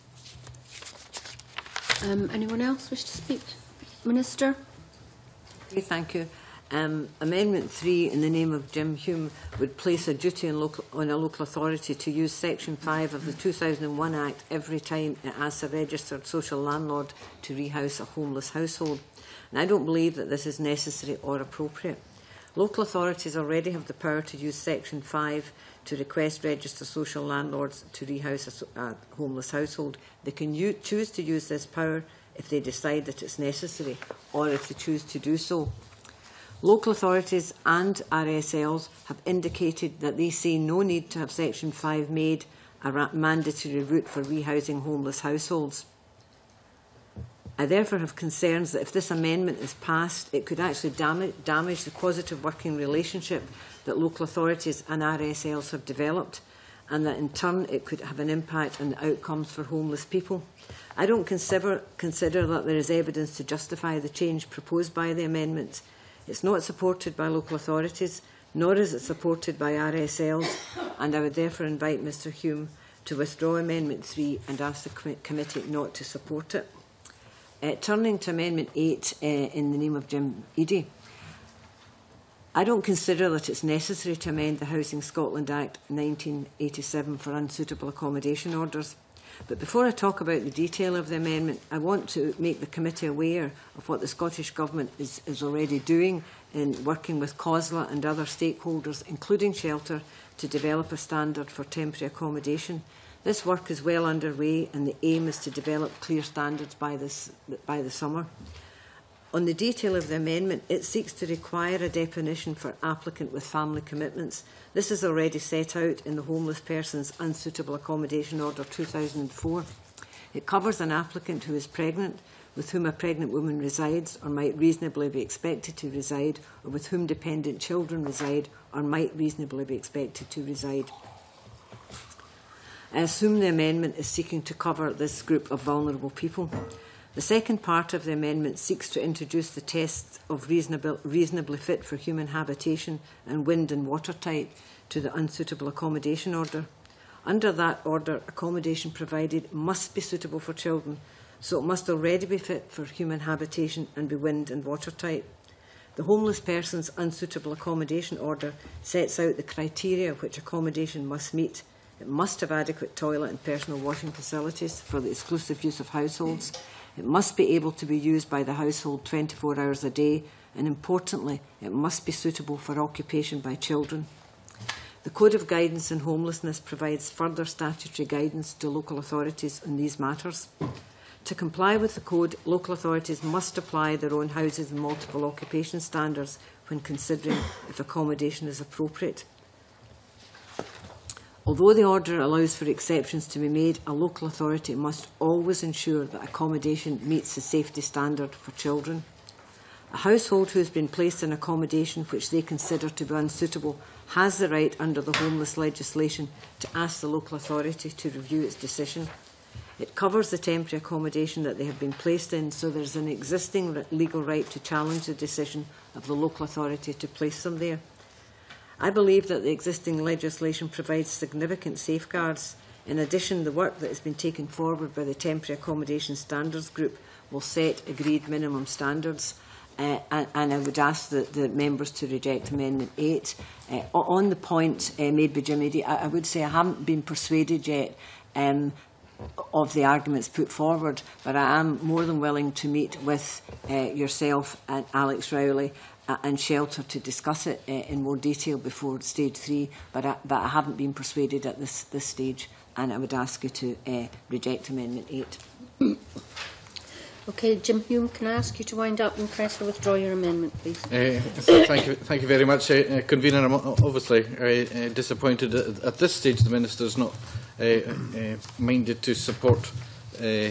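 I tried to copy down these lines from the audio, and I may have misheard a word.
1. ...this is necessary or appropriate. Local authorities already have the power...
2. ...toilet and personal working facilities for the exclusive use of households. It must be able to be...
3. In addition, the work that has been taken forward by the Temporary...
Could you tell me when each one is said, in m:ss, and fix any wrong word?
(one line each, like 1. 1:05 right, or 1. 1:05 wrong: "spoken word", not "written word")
1. 0:20 right
2. 2:42 wrong: "washing", not "working"
3. 3:42 right.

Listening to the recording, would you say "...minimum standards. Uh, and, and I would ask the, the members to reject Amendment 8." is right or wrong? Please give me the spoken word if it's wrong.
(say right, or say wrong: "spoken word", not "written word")
right.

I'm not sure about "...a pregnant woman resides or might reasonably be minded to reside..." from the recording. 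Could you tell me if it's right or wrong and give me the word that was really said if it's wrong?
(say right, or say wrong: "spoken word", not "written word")
wrong: "expected", not "minded".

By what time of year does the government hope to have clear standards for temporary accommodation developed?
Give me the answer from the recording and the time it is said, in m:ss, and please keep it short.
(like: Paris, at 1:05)
Summer, at 1:47.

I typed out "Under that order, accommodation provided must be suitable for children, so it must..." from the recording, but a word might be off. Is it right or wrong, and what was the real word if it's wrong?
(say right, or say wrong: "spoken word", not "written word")
right.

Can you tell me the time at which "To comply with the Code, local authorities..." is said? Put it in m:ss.
3:01.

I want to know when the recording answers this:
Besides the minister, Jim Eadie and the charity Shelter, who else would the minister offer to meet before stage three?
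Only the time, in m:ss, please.
4:04.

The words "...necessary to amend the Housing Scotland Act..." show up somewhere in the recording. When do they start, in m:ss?
1:23.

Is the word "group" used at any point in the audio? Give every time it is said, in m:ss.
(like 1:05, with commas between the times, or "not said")
2:15, 3:46.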